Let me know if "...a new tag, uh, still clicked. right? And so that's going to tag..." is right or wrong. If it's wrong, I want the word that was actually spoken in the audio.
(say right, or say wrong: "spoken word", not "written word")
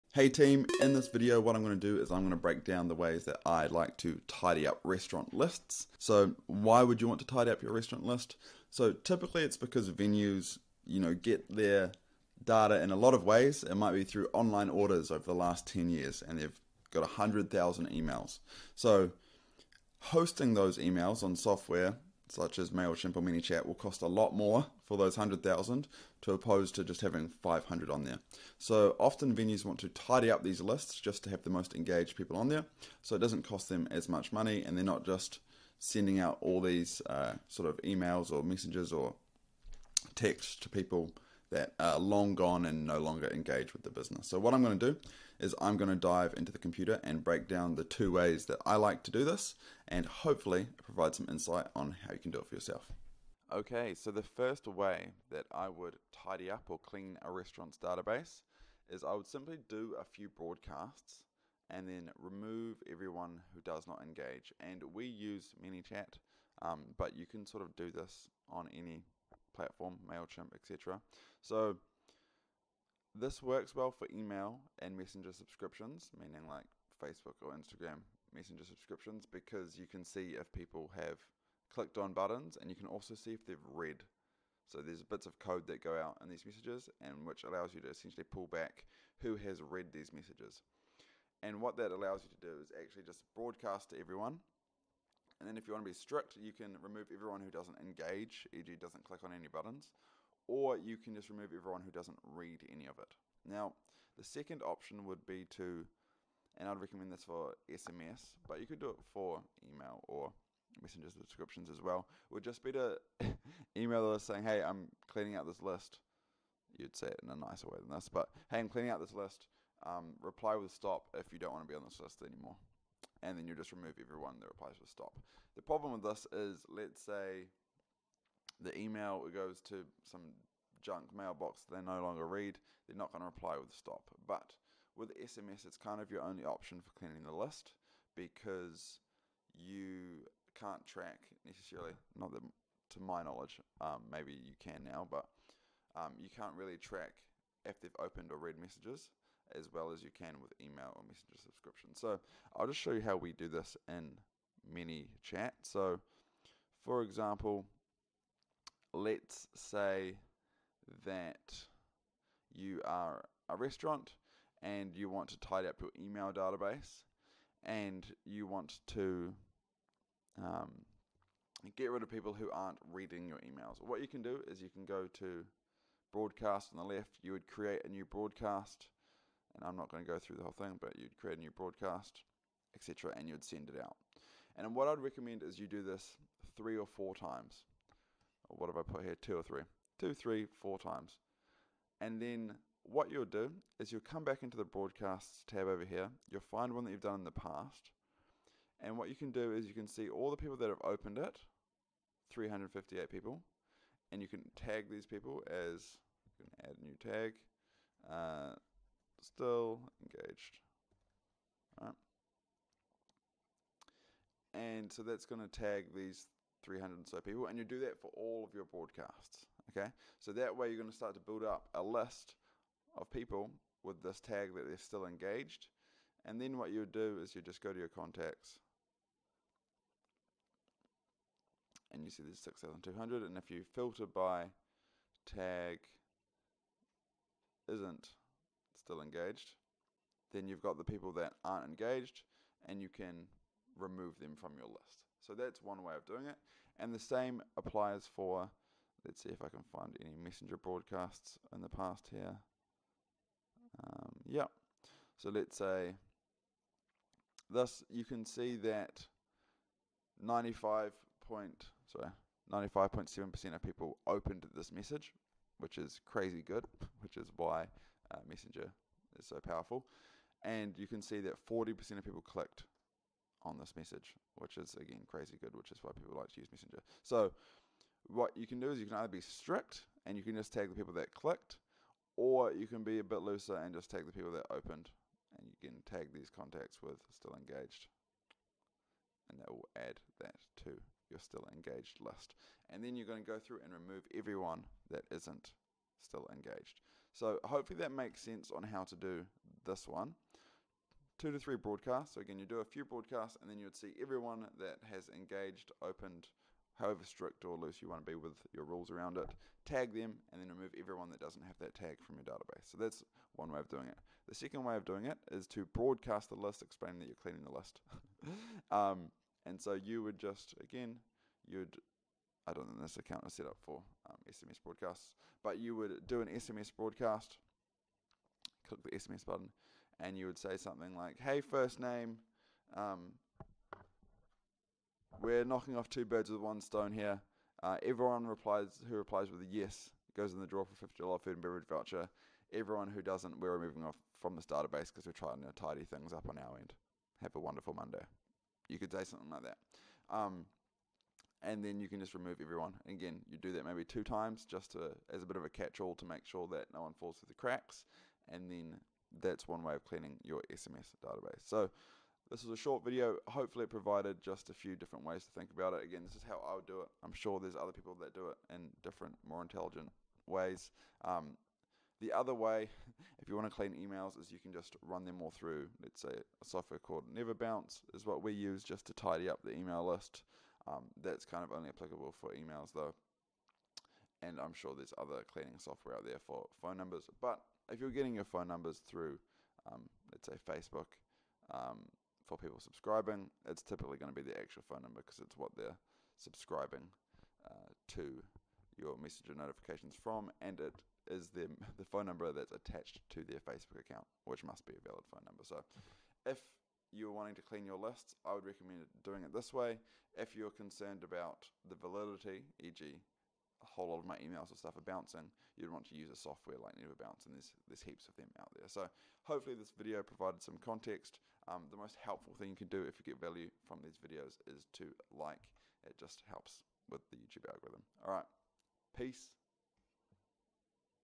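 wrong: "engaged", not "clicked".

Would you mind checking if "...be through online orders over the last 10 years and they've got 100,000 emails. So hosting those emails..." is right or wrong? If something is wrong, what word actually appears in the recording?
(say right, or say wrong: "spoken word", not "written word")
right.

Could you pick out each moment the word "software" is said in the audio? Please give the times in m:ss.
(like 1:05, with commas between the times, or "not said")
0:21, 6:16, 6:25, 6:56.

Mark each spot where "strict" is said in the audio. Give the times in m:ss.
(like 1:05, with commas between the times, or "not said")
1:35, 4:39, 5:07.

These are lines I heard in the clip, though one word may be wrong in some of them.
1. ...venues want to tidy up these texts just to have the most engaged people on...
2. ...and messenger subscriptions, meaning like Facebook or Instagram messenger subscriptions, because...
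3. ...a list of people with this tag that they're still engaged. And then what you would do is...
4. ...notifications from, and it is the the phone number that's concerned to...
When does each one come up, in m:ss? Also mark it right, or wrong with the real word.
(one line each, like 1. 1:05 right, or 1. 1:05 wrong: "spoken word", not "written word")
1. 0:29 wrong: "lists", not "texts"
2. 1:14 right
3. 3:41 right
4. 6:39 wrong: "attached", not "concerned".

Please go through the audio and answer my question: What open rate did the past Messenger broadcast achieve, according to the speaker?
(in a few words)
95.7%.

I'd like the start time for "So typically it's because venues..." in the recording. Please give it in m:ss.
0:08.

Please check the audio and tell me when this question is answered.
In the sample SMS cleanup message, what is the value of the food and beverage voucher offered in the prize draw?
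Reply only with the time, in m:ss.
5:40.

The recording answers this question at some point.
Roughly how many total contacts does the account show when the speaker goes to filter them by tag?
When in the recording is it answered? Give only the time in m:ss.
3:52.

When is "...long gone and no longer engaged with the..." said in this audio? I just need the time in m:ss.
0:41.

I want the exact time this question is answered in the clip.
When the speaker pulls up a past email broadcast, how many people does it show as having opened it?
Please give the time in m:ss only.
3:22.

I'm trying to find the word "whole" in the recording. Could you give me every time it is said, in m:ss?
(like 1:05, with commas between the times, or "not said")
3:00, 6:53.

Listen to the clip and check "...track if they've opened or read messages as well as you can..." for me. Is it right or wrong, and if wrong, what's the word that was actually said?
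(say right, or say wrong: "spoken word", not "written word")
right.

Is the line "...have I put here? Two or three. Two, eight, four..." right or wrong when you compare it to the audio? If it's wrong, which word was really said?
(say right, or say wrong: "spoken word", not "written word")
wrong: "three", not "eight".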